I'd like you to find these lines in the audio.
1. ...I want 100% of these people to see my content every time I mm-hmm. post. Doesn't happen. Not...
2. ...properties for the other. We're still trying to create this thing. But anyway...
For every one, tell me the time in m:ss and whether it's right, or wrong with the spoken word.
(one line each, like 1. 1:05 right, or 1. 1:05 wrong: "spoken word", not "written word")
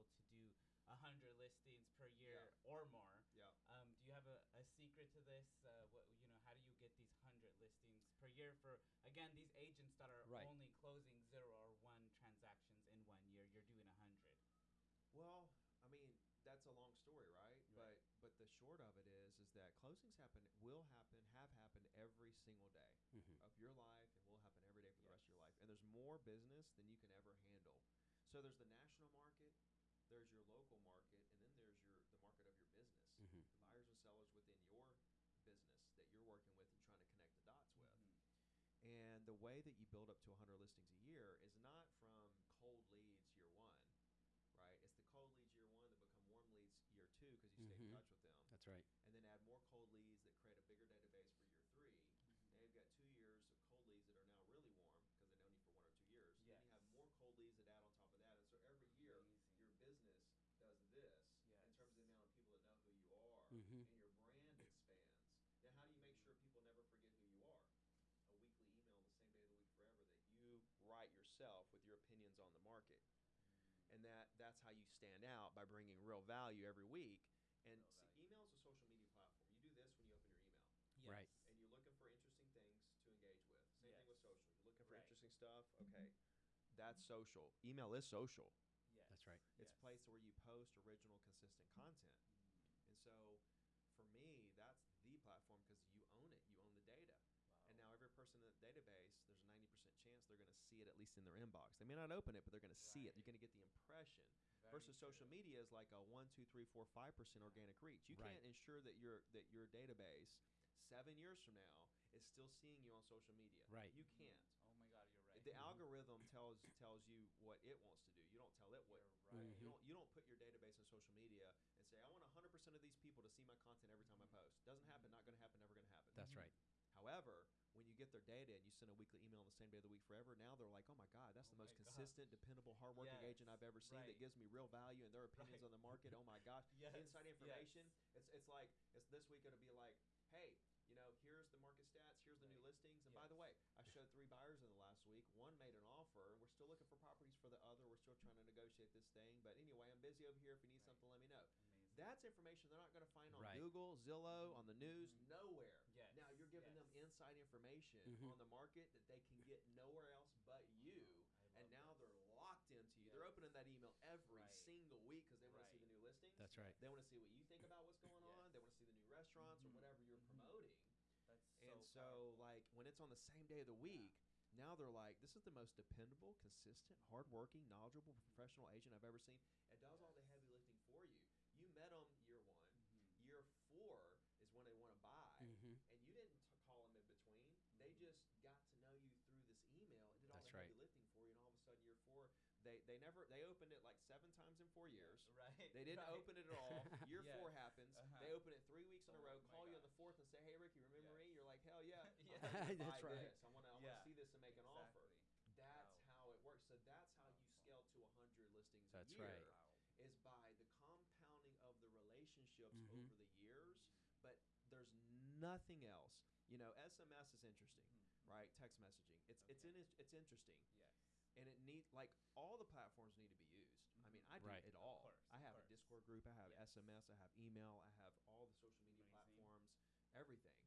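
1. 2:02 right
2. 2:26 wrong: "negotiate", not "create".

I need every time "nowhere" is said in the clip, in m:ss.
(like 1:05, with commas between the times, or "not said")
2:35, 2:39.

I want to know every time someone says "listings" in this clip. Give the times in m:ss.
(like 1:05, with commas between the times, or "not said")
0:01, 0:07, 0:40, 2:22, 2:46, 3:28.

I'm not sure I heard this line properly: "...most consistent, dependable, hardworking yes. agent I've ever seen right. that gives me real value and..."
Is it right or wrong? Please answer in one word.
right.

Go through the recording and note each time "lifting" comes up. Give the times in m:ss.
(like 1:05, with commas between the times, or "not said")
3:00, 3:10.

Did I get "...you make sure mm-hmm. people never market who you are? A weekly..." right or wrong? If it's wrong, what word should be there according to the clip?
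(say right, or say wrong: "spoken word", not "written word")
wrong: "forget", not "market".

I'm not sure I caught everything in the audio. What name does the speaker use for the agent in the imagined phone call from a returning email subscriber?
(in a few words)
Ricky.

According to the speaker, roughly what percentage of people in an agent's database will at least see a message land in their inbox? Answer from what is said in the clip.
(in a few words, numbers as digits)
90%.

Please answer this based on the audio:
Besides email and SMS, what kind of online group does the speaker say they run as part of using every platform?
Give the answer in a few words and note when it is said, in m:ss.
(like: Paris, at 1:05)
Discord, at 3:45.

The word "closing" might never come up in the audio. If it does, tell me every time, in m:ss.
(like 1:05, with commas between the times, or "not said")
0:10, 0:19.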